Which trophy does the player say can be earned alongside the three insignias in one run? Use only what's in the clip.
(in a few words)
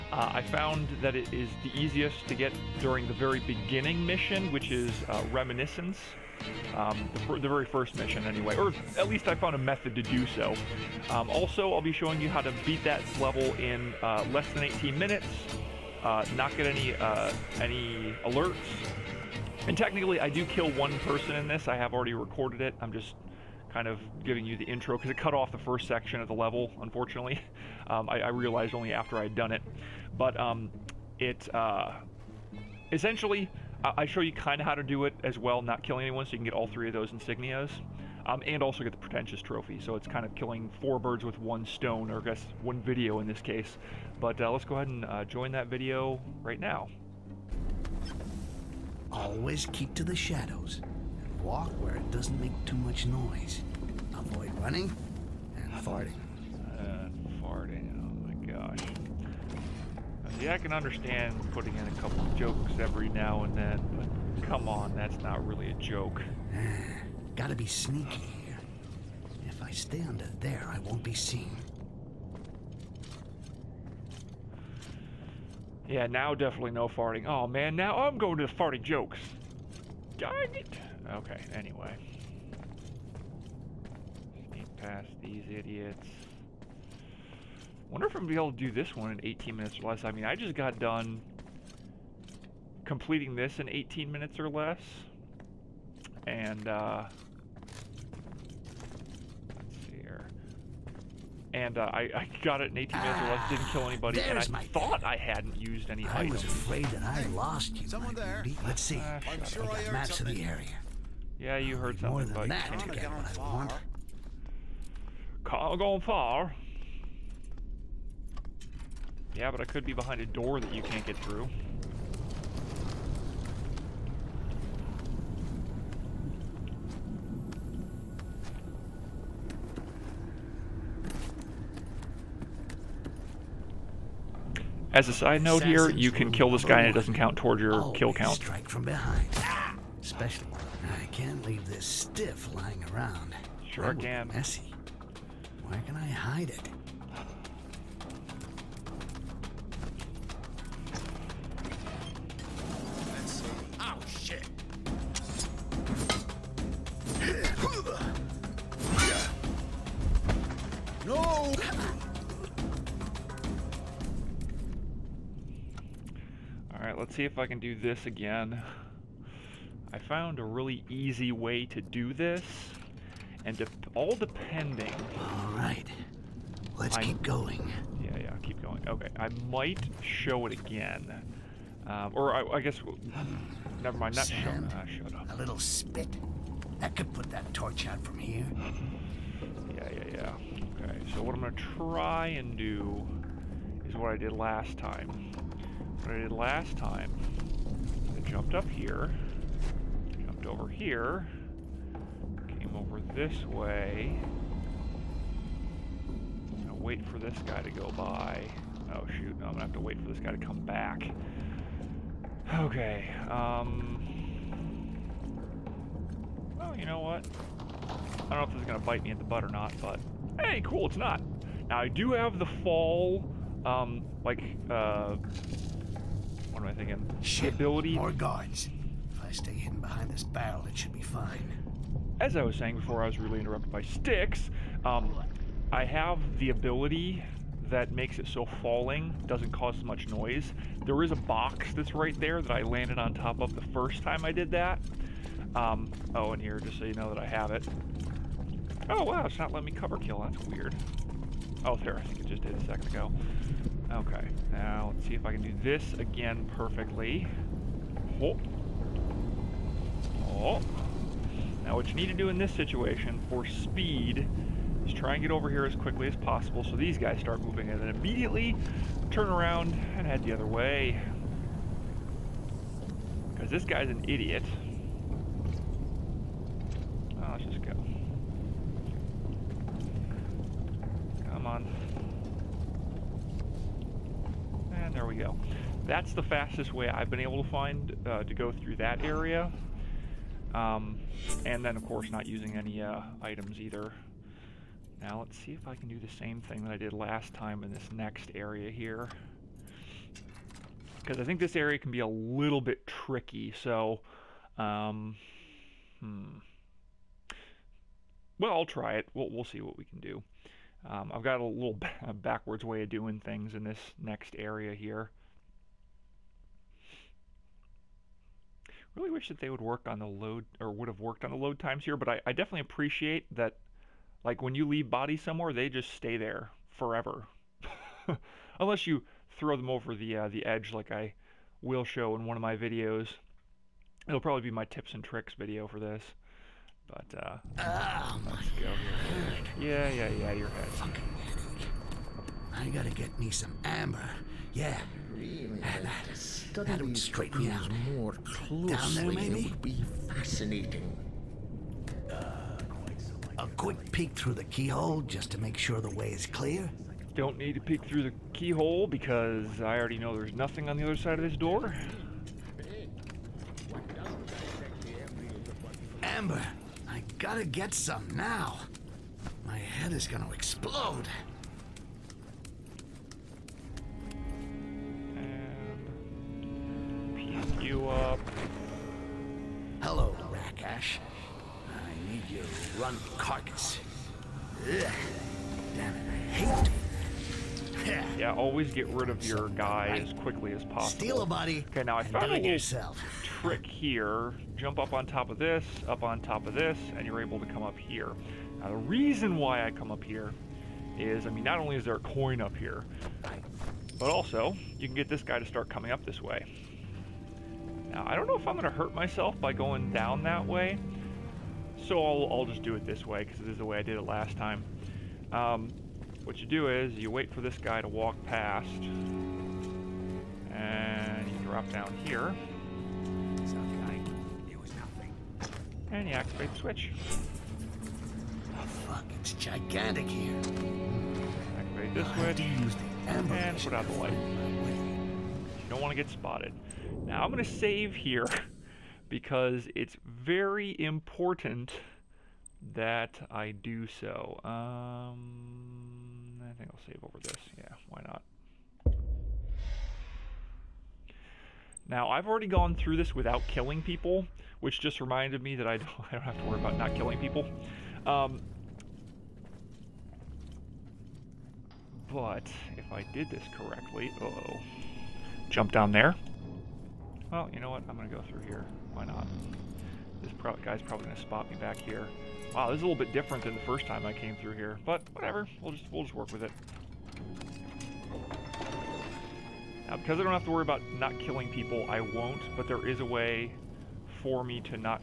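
pretentious trophy.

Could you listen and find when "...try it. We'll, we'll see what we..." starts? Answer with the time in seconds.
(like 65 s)
308 s.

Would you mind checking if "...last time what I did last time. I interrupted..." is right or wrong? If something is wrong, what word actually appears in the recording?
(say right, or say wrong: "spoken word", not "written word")
wrong: "jumped", not "interrupted".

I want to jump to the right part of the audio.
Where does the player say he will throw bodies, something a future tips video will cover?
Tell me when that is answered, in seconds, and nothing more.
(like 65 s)
330 s.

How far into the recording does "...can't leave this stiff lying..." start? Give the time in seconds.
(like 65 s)
141 s.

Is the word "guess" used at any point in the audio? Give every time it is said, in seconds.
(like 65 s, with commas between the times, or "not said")
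42 s, 182 s.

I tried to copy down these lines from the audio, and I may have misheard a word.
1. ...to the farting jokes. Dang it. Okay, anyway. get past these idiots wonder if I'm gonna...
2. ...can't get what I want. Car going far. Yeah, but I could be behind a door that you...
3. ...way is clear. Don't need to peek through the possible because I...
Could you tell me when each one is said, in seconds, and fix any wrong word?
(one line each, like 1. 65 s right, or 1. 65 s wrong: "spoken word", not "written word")
1. 78 s right
2. 112 s right
3. 355 s wrong: "keyhole", not "possible".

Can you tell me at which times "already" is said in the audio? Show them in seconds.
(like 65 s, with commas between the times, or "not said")
21 s, 359 s, 452 s.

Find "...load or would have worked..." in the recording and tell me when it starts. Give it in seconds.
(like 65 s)
320 s.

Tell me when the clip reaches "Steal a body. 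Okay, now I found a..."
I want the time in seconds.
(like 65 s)
391 s.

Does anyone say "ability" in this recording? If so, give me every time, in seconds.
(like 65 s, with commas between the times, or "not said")
227 s, 236 s.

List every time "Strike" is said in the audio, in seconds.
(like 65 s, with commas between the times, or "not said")
138 s.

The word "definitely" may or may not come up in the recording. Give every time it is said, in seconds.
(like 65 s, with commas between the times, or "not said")
76 s, 322 s.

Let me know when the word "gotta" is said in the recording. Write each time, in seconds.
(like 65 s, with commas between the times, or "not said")
67 s, 342 s, 367 s.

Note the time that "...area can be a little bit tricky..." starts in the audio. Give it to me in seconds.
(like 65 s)
301 s.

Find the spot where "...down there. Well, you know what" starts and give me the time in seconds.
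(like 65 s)
465 s.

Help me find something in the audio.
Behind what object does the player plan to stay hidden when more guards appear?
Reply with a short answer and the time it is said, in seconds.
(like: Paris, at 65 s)
barrel, at 230 s.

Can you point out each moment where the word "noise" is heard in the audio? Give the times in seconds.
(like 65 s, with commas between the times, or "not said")
53 s, 240 s.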